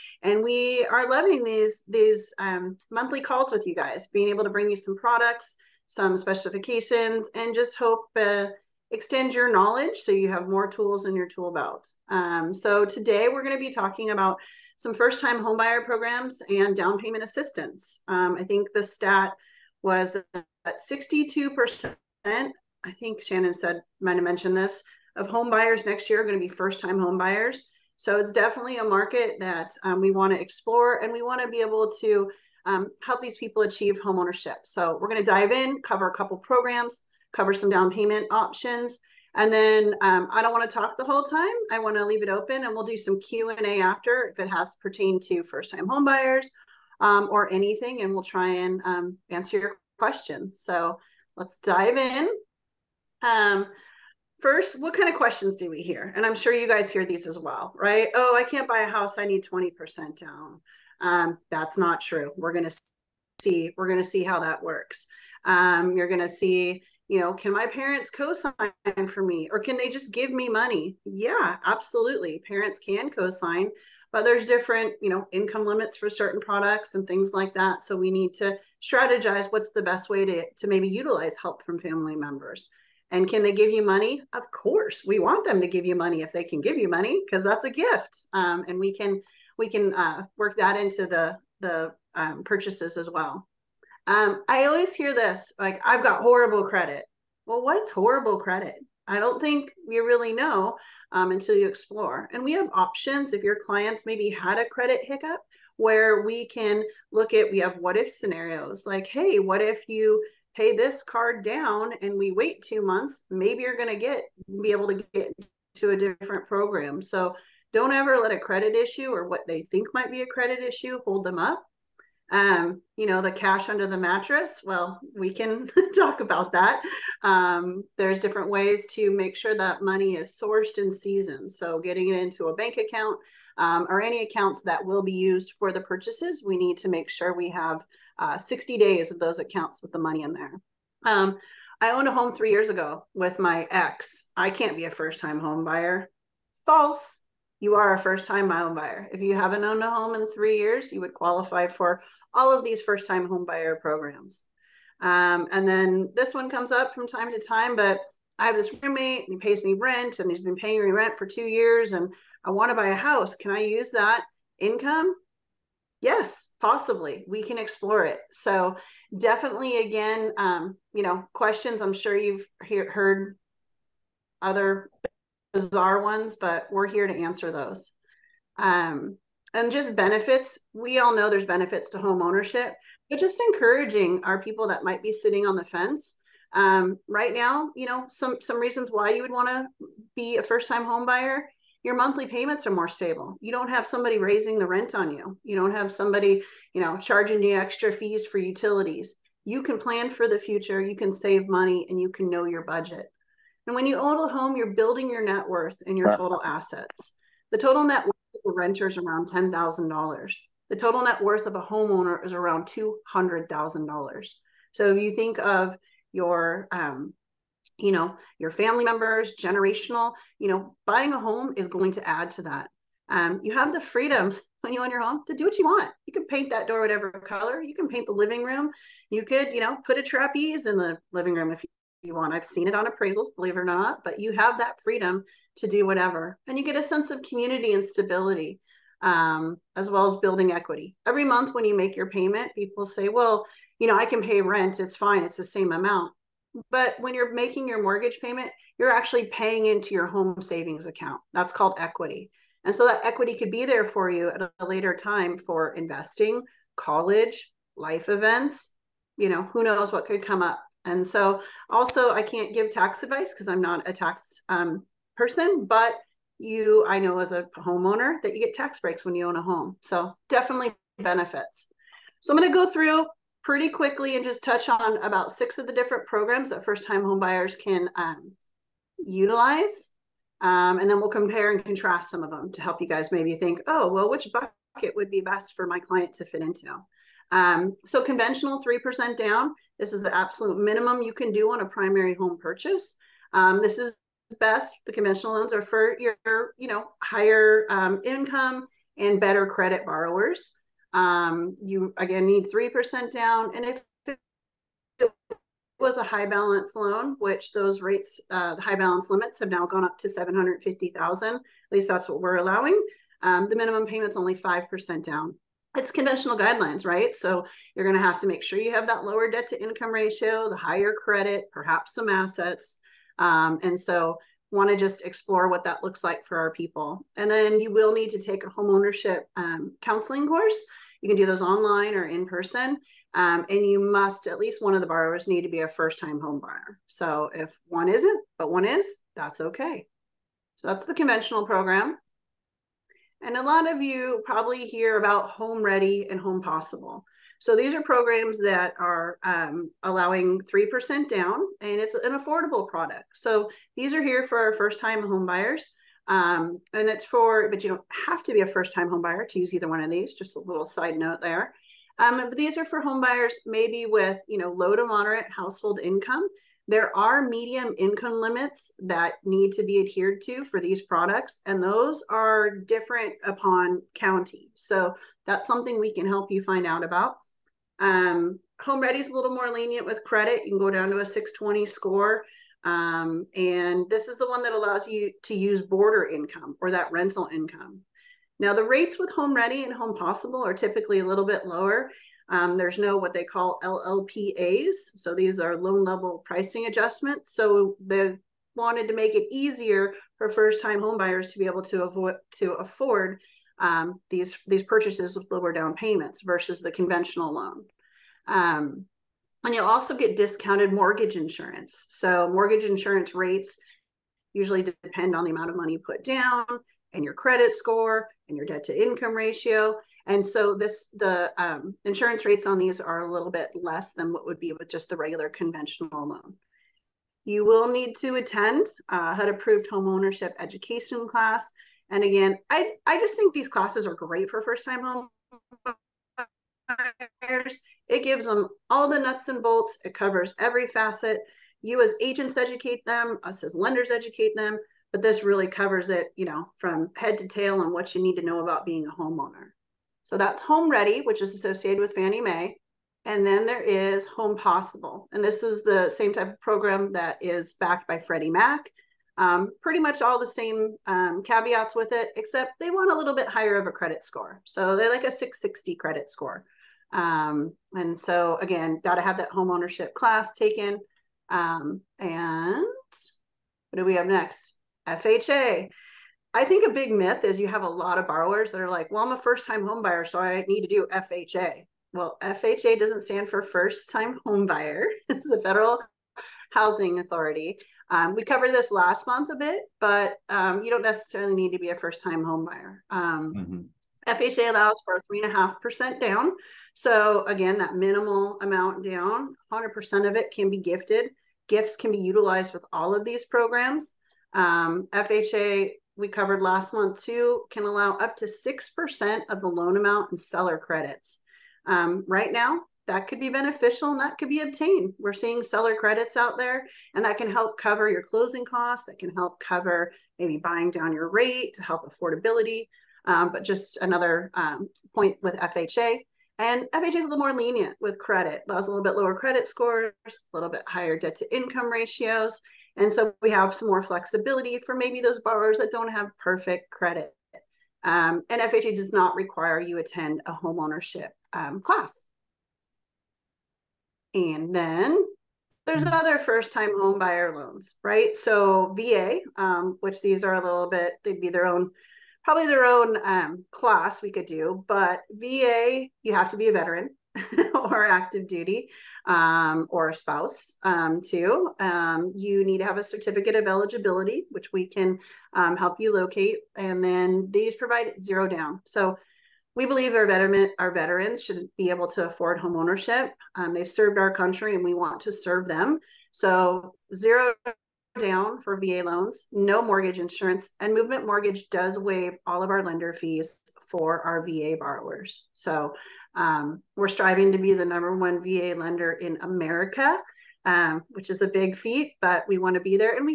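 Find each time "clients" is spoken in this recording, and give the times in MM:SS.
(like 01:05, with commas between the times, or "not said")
01:43, 04:45.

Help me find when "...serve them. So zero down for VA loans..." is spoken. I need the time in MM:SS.
09:35.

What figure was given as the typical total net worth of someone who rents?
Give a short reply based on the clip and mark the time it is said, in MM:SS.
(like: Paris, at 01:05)
$10,000, at 03:29.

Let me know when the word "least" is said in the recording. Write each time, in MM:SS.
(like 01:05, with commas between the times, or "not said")
05:11, 05:34.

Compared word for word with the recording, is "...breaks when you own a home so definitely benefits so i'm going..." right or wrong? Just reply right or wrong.
right.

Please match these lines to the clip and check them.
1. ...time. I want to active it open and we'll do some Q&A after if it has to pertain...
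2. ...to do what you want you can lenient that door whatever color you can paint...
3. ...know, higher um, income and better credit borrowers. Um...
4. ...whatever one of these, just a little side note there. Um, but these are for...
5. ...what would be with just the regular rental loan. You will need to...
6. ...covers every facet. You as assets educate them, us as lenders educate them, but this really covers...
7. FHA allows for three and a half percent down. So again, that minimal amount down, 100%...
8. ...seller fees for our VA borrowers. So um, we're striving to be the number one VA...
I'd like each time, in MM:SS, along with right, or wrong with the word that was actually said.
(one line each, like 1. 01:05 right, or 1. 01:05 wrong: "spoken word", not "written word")
1. 00:41 wrong: "leave", not "active"
2. 03:45 wrong: "paint", not "lenient"
3. 04:56 right
4. 05:59 wrong: "either", not "whatever"
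5. 07:04 wrong: "conventional", not "rental"
6. 07:19 wrong: "agents", not "assets"
7. 08:14 right
8. 09:42 wrong: "lender", not "seller".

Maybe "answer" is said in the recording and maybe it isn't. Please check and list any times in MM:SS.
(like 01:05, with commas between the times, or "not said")
00:49, 02:57.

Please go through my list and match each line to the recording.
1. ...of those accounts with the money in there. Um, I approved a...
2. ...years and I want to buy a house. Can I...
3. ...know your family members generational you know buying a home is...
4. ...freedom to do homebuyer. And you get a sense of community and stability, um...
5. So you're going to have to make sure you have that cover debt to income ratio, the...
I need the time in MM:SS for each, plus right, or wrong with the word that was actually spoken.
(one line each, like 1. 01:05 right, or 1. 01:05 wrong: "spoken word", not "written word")
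1. 02:19 wrong: "owned", not "approved"
2. 02:41 right
3. 03:37 right
4. 03:54 wrong: "whatever", not "homebuyer"
5. 05:17 wrong: "lower", not "cover".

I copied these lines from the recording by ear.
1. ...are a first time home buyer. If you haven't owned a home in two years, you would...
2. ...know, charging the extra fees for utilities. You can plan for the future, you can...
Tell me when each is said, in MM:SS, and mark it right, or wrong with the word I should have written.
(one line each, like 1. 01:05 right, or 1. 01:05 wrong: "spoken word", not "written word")
1. 02:27 wrong: "three", not "two"
2. 03:16 right.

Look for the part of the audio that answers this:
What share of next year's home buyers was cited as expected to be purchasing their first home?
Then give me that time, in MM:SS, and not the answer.
00:20.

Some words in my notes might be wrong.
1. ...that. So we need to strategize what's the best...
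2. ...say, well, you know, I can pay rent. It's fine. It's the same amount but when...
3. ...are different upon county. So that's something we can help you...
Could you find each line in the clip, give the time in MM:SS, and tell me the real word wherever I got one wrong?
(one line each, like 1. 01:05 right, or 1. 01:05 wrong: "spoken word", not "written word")
1. 01:17 right
2. 04:02 right
3. 06:12 right.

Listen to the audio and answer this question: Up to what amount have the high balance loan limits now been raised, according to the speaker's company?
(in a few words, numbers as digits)
750,000.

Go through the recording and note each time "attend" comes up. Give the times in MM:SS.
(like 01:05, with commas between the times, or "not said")
07:08, 08:59.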